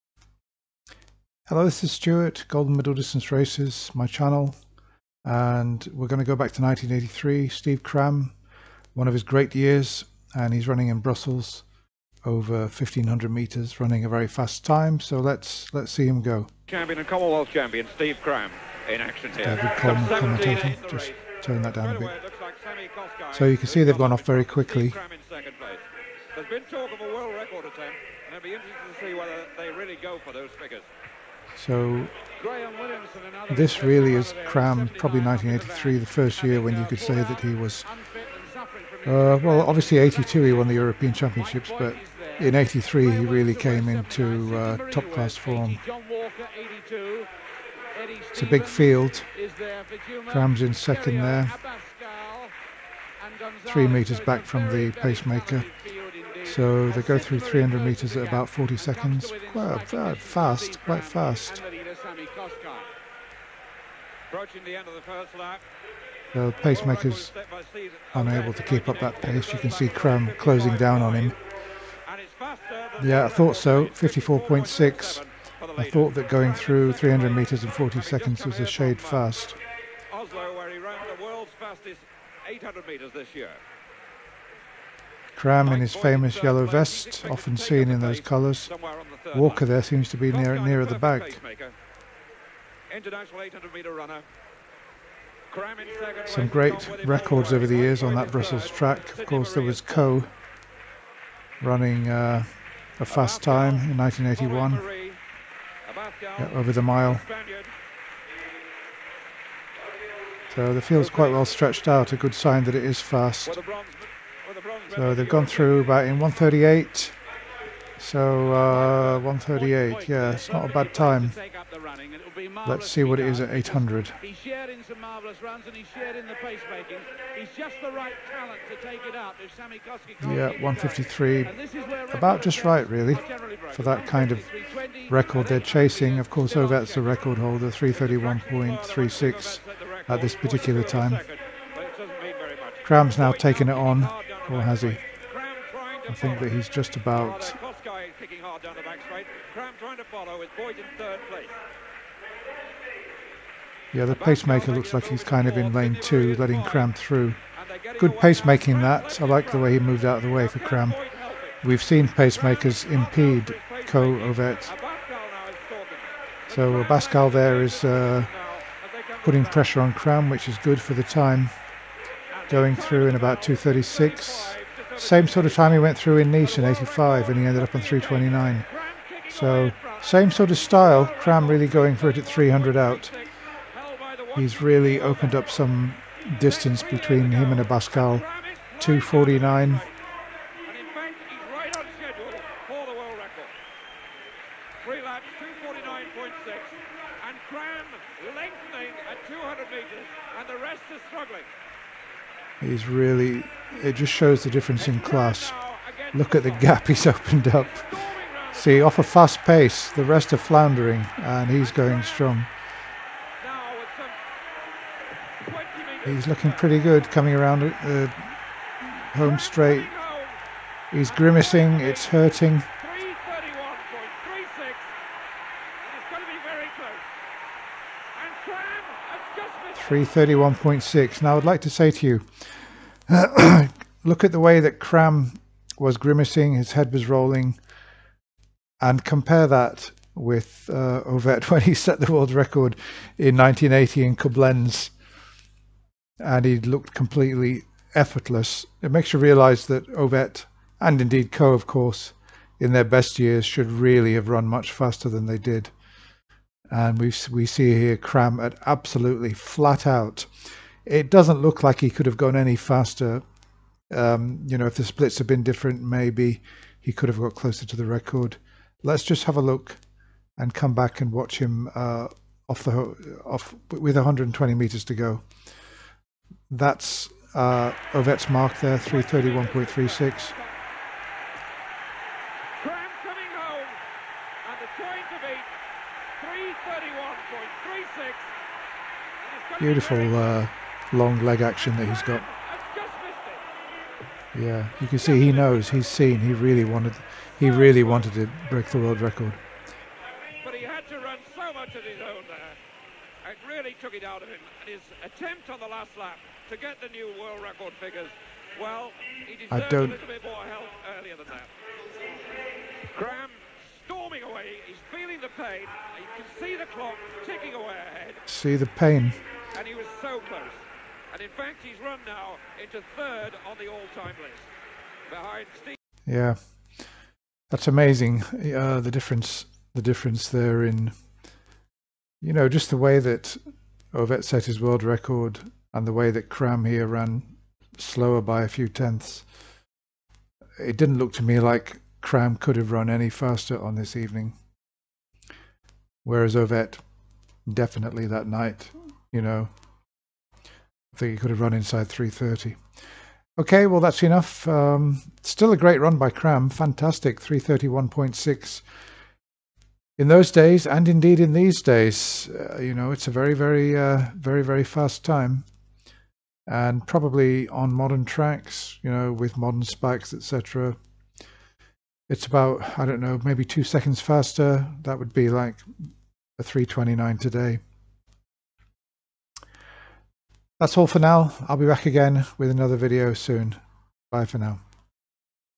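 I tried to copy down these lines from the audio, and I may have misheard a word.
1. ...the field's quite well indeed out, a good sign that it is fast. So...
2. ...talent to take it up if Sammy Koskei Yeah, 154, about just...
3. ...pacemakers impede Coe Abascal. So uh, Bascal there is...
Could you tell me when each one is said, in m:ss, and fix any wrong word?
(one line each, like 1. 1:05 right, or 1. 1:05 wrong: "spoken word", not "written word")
1. 1:50 wrong: "stretched", not "indeed"
2. 2:08 wrong: "153", not "154"
3. 2:42 wrong: "Ovett", not "Abascal".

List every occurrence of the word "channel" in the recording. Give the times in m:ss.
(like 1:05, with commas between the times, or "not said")
0:04.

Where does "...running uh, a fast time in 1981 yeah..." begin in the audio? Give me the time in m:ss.
1:41.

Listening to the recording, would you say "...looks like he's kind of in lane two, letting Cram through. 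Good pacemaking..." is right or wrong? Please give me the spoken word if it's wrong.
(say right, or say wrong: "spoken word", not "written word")
right.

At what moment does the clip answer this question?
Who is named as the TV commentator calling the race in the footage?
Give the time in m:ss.
0:19.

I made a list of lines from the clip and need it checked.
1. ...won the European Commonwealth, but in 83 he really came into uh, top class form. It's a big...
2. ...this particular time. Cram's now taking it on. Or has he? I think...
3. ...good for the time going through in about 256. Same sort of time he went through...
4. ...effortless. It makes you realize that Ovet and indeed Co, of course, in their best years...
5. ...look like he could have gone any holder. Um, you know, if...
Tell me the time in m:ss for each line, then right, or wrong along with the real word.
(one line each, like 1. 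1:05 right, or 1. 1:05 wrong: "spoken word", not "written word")
1. 0:40 wrong: "Championships", not "Commonwealth"
2. 2:20 right
3. 2:50 wrong: "236", not "256"
4. 4:07 right
5. 4:21 wrong: "faster", not "holder".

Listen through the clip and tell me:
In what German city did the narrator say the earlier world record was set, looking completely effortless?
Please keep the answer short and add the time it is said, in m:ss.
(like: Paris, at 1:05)
Koblenz, at 4:04.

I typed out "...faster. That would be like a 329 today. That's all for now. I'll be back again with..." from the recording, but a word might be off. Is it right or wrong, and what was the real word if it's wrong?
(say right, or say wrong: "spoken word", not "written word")
right.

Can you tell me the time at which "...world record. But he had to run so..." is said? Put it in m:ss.
4:58.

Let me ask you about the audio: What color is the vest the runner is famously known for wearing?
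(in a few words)
yellow.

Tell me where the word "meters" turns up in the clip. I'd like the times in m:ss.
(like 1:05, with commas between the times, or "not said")
0:13, 0:57, 1:17, 1:22, 4:34.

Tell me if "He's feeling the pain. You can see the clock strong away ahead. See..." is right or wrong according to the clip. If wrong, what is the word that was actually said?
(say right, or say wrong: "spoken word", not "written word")
wrong: "ticking", not "strong".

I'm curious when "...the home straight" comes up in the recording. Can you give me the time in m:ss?
3:37.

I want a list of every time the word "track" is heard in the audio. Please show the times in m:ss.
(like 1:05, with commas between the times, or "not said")
1:38, 6:08.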